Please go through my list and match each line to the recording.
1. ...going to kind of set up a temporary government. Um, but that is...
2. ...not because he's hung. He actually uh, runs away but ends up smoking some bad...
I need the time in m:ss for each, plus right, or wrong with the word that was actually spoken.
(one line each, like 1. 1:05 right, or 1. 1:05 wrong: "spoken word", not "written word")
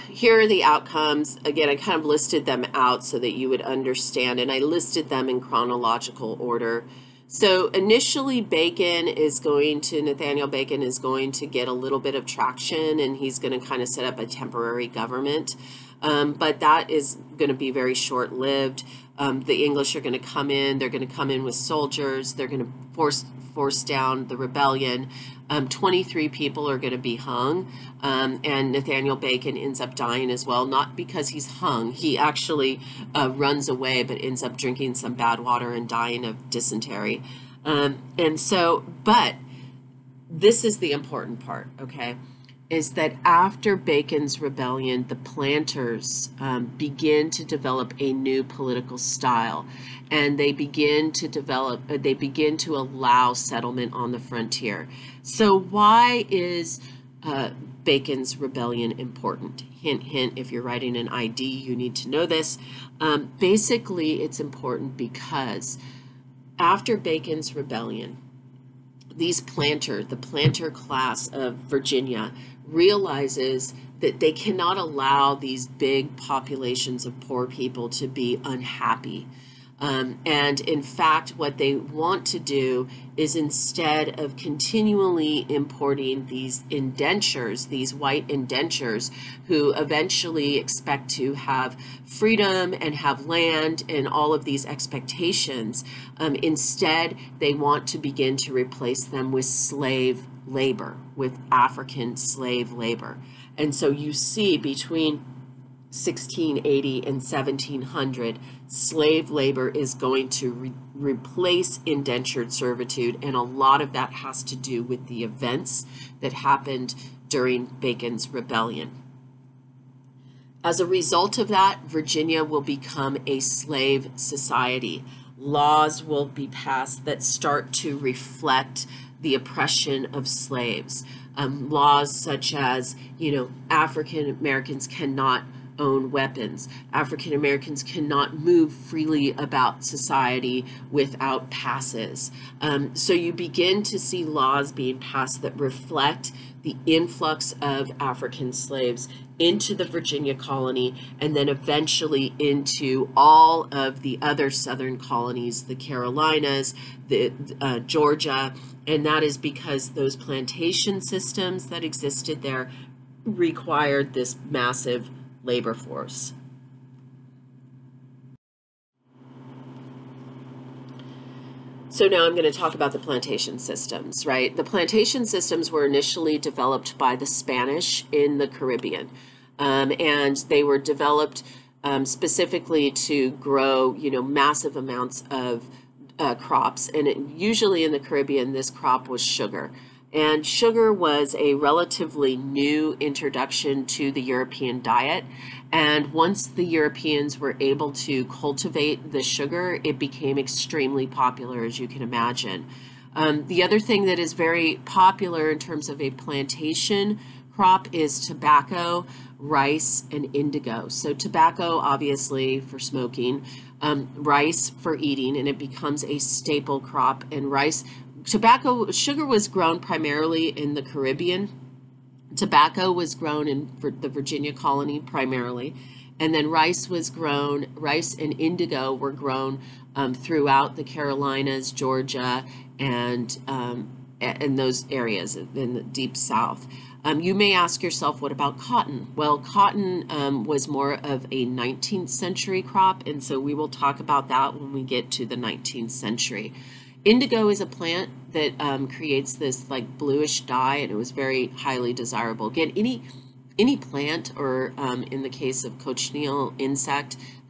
1. 0:13 right
2. 0:30 wrong: "drinking", not "smoking".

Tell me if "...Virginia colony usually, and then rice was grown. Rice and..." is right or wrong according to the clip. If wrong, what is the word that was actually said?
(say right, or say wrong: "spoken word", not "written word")
wrong: "primarily", not "usually".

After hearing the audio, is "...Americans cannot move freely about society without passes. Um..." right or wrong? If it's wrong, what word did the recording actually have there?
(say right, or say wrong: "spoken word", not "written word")
right.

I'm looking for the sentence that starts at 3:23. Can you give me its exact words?
Um, the other thing that is very popular in terms of a plantation crop is tobacco, rice, and indigo.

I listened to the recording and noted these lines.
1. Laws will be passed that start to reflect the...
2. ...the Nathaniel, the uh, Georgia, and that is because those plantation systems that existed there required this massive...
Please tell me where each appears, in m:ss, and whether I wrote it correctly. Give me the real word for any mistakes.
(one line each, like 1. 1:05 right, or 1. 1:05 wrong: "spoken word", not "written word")
1. 2:05 right
2. 2:35 wrong: "Carolinas", not "Nathaniel".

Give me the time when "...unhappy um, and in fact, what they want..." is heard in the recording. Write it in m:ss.
1:18.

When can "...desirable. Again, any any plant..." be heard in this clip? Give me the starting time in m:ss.
4:11.